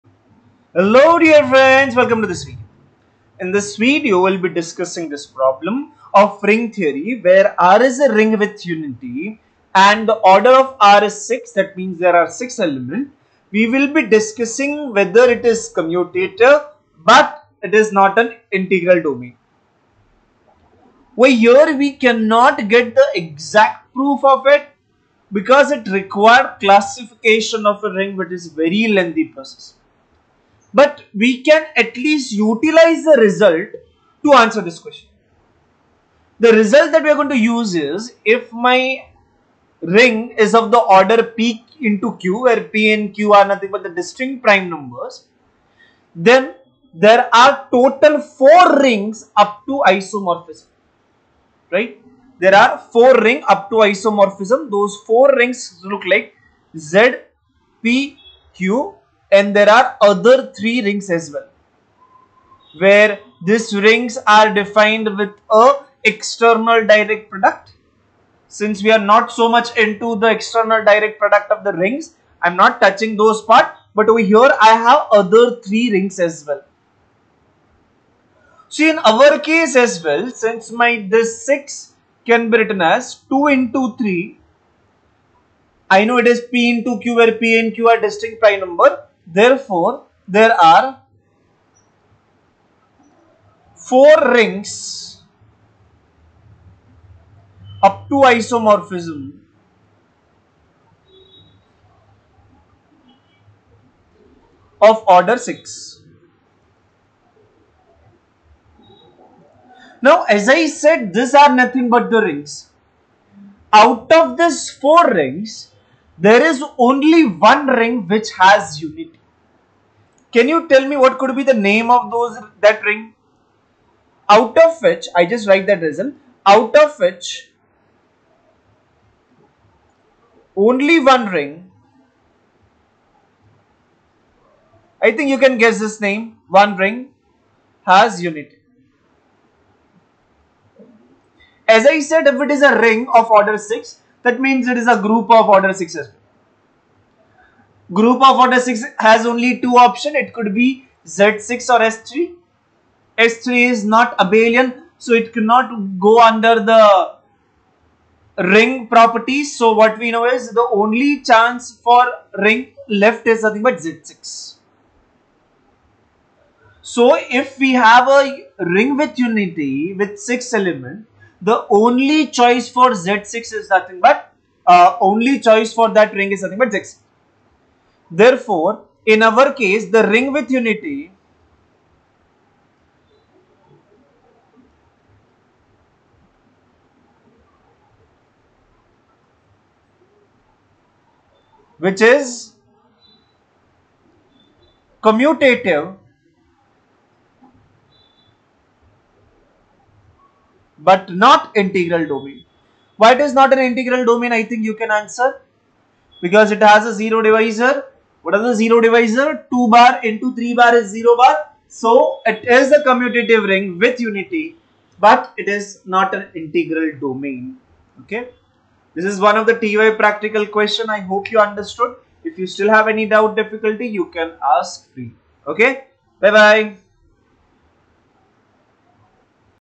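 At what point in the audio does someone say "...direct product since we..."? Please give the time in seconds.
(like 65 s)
66 s.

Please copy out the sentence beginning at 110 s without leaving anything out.
Now, as I said, these are nothing but the rings.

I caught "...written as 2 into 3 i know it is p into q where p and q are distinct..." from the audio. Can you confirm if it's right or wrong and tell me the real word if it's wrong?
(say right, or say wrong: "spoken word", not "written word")
right.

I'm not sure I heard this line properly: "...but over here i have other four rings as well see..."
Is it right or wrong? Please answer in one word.
wrong.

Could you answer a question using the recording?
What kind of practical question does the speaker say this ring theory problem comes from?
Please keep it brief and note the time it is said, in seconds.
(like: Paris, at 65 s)
TY practical question, at 219 s.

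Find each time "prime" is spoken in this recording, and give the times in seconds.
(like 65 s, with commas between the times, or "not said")
44 s, 88 s.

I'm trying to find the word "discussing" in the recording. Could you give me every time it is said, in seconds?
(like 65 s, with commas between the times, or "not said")
4 s, 14 s.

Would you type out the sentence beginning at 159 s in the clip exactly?
So what we know is the only chance for ring left is nothing but Z6.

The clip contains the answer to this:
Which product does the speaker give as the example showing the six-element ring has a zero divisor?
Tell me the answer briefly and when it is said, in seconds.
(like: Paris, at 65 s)
2 bar into 3 bar, at 209 s.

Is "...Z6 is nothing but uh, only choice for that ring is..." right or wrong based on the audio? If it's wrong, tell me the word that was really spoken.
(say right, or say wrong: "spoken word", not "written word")
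right.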